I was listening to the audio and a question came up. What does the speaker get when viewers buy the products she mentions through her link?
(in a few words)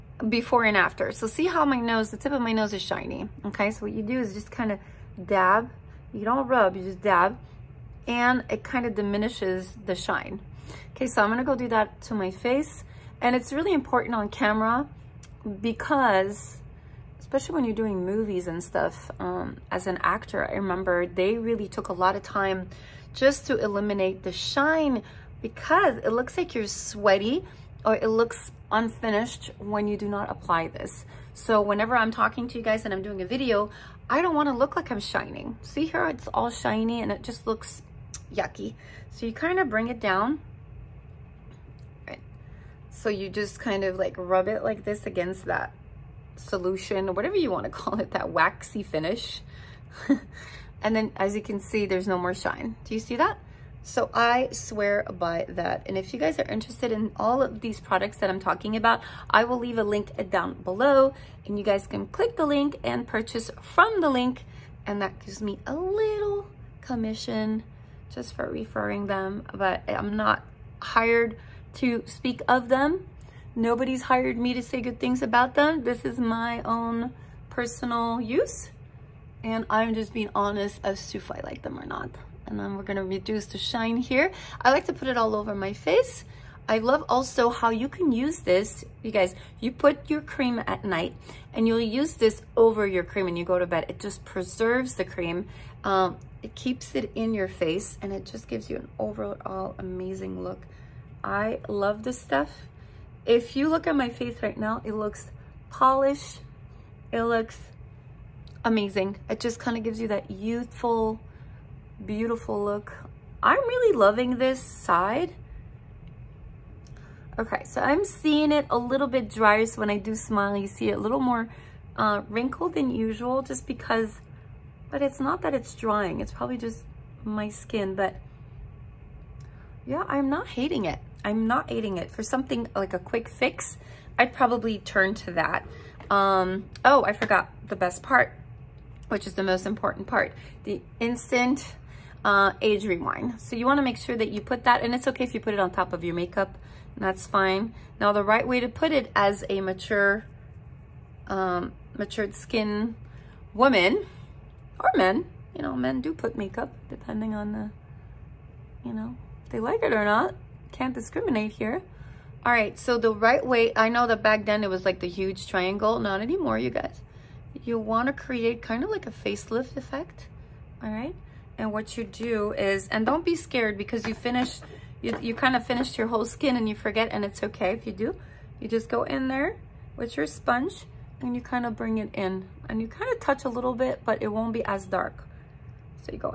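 a little commission.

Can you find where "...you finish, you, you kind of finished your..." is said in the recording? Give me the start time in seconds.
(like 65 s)
174 s.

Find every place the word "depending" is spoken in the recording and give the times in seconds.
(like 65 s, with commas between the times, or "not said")
156 s.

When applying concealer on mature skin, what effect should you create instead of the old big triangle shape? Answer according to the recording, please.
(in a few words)
facelift effect.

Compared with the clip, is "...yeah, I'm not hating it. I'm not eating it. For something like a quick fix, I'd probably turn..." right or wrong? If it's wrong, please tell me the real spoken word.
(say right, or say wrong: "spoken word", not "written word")
right.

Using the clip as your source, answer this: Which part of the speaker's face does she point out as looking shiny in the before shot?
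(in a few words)
tip of my nose.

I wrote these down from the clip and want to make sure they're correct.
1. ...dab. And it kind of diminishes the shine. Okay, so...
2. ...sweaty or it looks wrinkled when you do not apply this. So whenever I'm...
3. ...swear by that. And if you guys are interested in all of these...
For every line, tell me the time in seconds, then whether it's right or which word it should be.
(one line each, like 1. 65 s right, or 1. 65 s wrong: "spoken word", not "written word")
1. 7 s right
2. 26 s wrong: "unfinished", not "wrinkled"
3. 54 s right.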